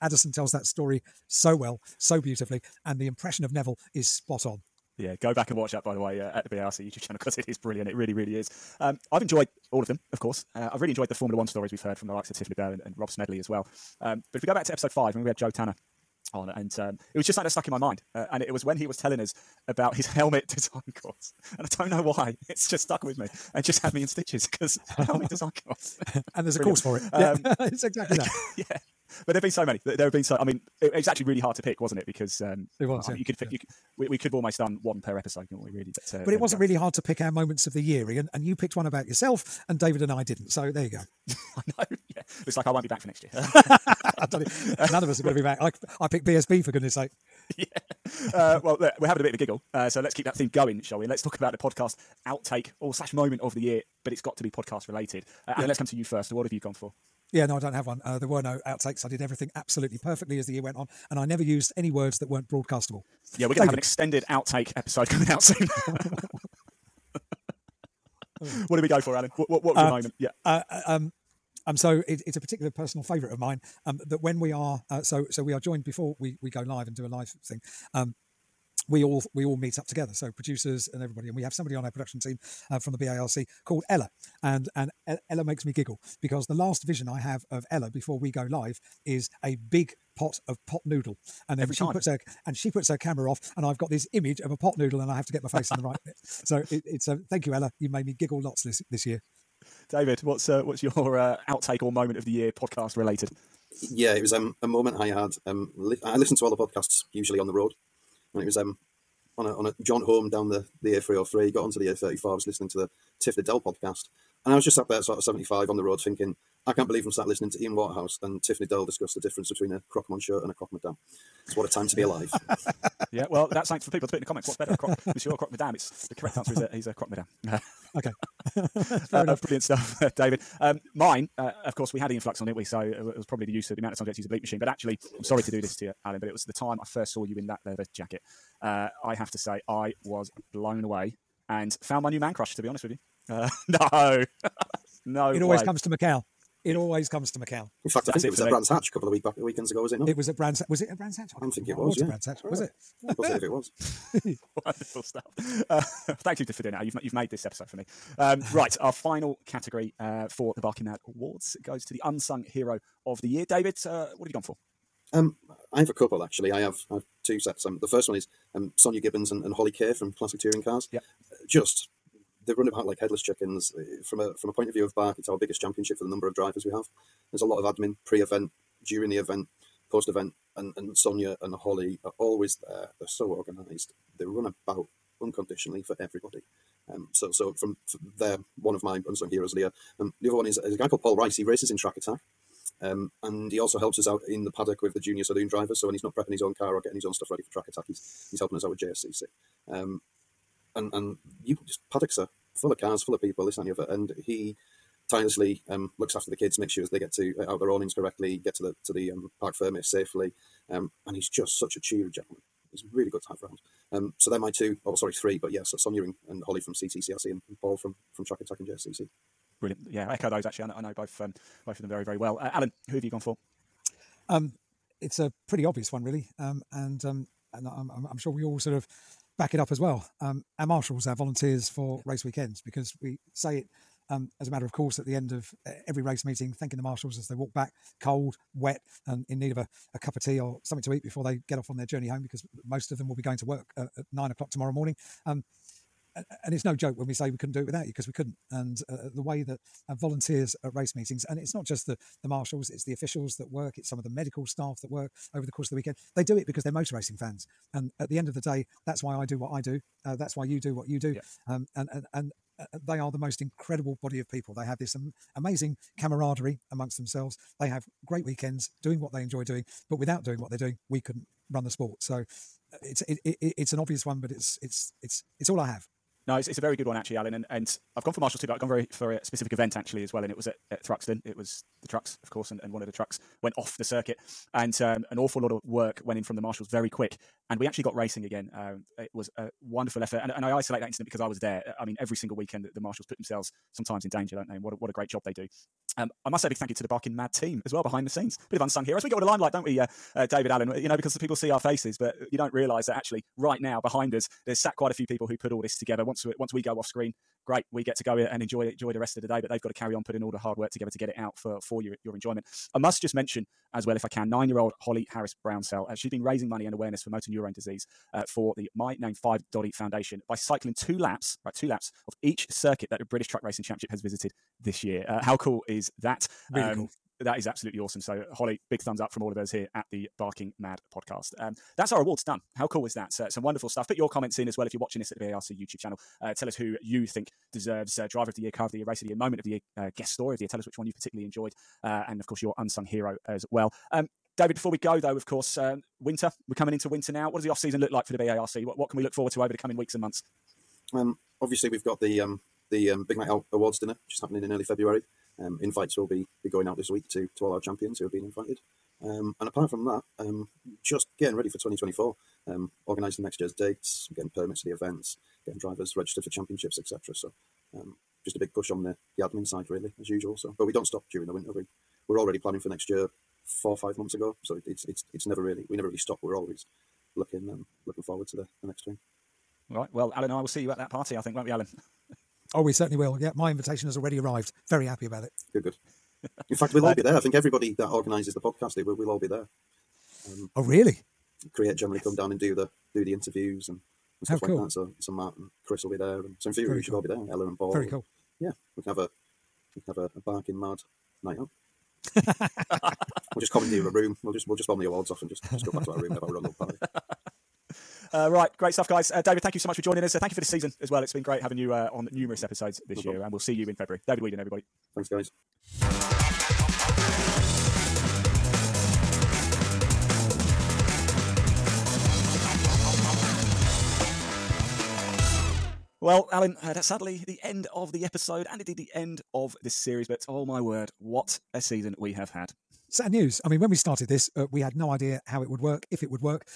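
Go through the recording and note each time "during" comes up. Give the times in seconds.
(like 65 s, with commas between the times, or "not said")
178 s, 371 s.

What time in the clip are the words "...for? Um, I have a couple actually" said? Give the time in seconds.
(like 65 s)
164 s.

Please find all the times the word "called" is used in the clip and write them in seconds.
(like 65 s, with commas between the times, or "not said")
83 s, 190 s.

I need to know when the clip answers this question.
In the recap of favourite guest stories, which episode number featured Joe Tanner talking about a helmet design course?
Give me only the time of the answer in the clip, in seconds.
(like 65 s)
14 s.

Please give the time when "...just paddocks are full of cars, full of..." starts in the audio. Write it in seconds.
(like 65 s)
201 s.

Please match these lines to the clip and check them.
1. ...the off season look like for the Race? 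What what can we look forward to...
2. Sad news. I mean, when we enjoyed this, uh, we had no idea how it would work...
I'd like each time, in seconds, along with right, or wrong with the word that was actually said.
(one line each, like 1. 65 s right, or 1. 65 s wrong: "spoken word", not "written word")
1. 347 s wrong: "BARC", not "Race"
2. 432 s wrong: "started", not "enjoyed".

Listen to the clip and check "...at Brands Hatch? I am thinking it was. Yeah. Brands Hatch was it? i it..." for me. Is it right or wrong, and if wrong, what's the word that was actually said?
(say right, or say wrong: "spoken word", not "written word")
right.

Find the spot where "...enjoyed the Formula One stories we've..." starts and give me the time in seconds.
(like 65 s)
10 s.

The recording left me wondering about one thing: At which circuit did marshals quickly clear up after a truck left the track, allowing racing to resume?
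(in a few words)
Thruxton.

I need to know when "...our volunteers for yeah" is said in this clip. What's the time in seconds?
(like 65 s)
231 s.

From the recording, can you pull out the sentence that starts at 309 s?
But they've got to carry on putting all the hard work together to get it out for for your your enjoyment.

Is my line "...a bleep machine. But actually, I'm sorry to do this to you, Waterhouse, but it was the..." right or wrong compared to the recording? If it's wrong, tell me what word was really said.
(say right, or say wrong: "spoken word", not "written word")
wrong: "Alan", not "Waterhouse".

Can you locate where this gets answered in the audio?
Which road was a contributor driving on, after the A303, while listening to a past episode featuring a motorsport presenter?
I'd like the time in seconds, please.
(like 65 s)
111 s.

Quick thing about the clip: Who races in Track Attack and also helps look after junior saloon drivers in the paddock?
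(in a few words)
Paul Rice.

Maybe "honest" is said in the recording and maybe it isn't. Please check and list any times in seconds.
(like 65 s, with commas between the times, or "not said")
142 s.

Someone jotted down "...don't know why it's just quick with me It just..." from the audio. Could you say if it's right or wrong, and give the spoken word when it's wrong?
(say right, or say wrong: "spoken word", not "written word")
wrong: "stuck", not "quick".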